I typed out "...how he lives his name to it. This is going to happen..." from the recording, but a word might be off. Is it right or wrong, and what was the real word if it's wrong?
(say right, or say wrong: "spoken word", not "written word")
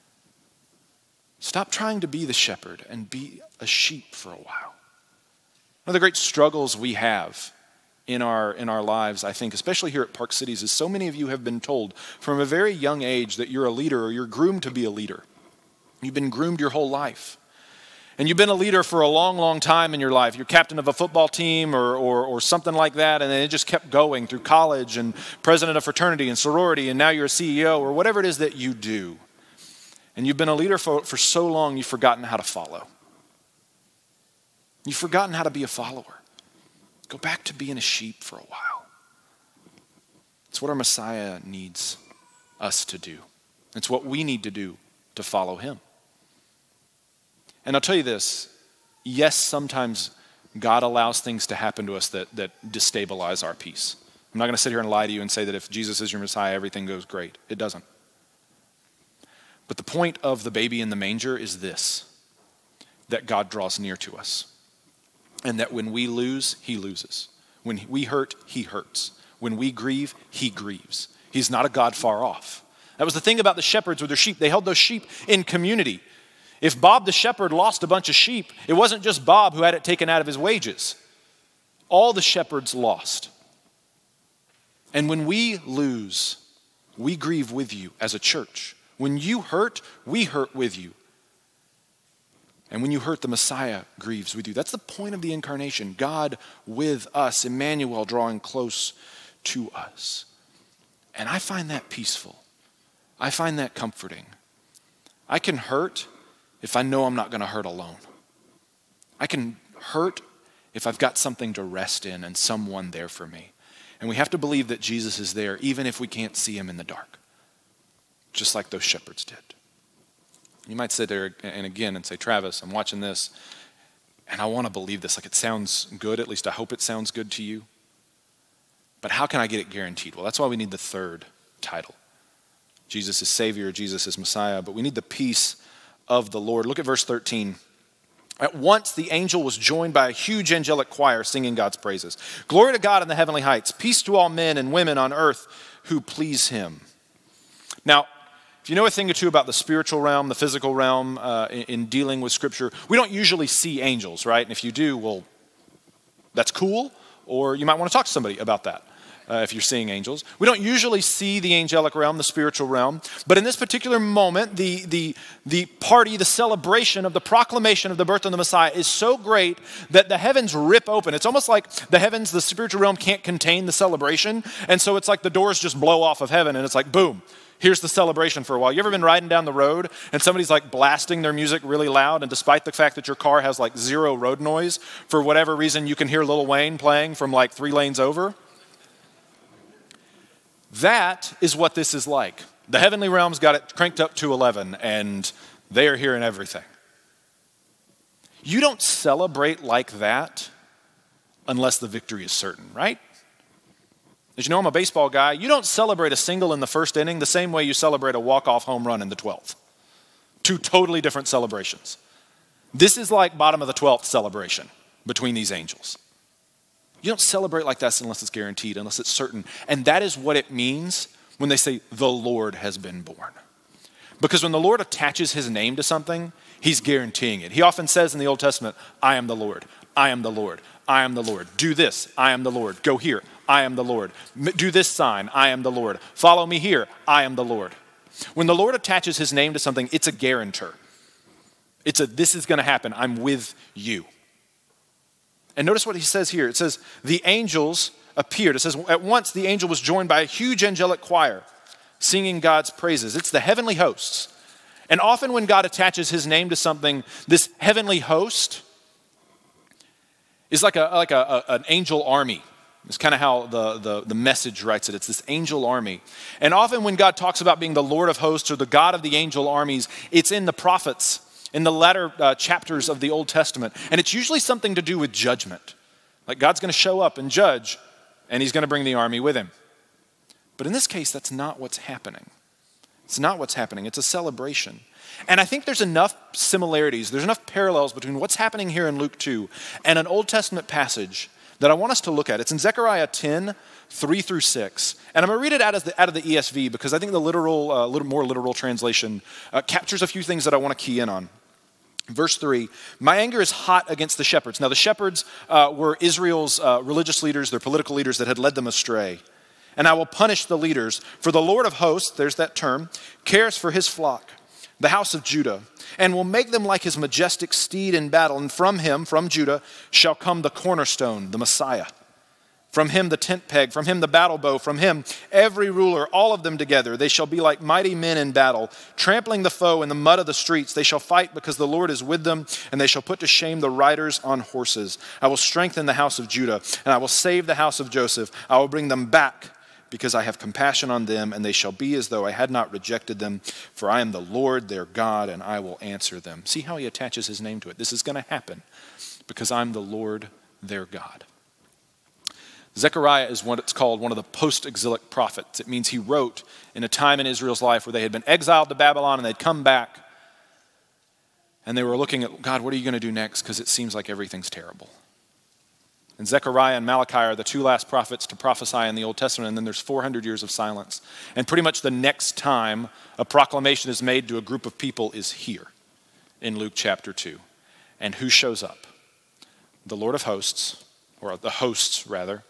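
wrong: "attaches", not "lives".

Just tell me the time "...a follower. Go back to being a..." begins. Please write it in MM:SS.
00:35.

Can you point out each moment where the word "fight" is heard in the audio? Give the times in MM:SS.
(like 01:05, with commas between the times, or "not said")
05:30.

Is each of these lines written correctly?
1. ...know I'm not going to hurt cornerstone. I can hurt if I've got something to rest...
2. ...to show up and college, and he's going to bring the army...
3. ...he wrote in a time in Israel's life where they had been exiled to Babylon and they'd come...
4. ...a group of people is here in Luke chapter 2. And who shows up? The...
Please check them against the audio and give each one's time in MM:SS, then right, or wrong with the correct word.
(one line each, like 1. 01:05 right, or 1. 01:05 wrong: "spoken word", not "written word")
1. 01:46 wrong: "alone", not "cornerstone"
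2. 04:36 wrong: "judge", not "college"
3. 05:55 right
4. 06:14 right.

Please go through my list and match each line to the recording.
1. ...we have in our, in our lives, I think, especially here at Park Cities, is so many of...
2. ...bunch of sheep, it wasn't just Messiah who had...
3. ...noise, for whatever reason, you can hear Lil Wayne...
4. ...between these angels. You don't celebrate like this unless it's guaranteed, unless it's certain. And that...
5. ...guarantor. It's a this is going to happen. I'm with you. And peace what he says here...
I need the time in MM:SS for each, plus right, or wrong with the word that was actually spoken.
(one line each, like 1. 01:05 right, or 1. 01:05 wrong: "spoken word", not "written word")
1. 00:06 right
2. 01:17 wrong: "Bob", not "Messiah"
3. 03:04 right
4. 03:35 right
5. 04:00 wrong: "notice", not "peace".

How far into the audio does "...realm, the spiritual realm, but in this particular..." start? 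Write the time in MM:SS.
02:41.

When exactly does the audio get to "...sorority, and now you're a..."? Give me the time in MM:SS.
00:26.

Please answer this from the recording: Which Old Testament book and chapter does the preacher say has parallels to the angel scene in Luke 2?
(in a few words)
Zechariah 10.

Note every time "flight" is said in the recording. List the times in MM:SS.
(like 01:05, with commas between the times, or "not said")
not said.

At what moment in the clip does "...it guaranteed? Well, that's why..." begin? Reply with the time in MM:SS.
02:09.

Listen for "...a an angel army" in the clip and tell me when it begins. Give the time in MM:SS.
04:21.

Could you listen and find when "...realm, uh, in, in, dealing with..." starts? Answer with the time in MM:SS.
02:30.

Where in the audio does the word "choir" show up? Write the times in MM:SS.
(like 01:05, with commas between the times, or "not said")
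02:20, 04:11.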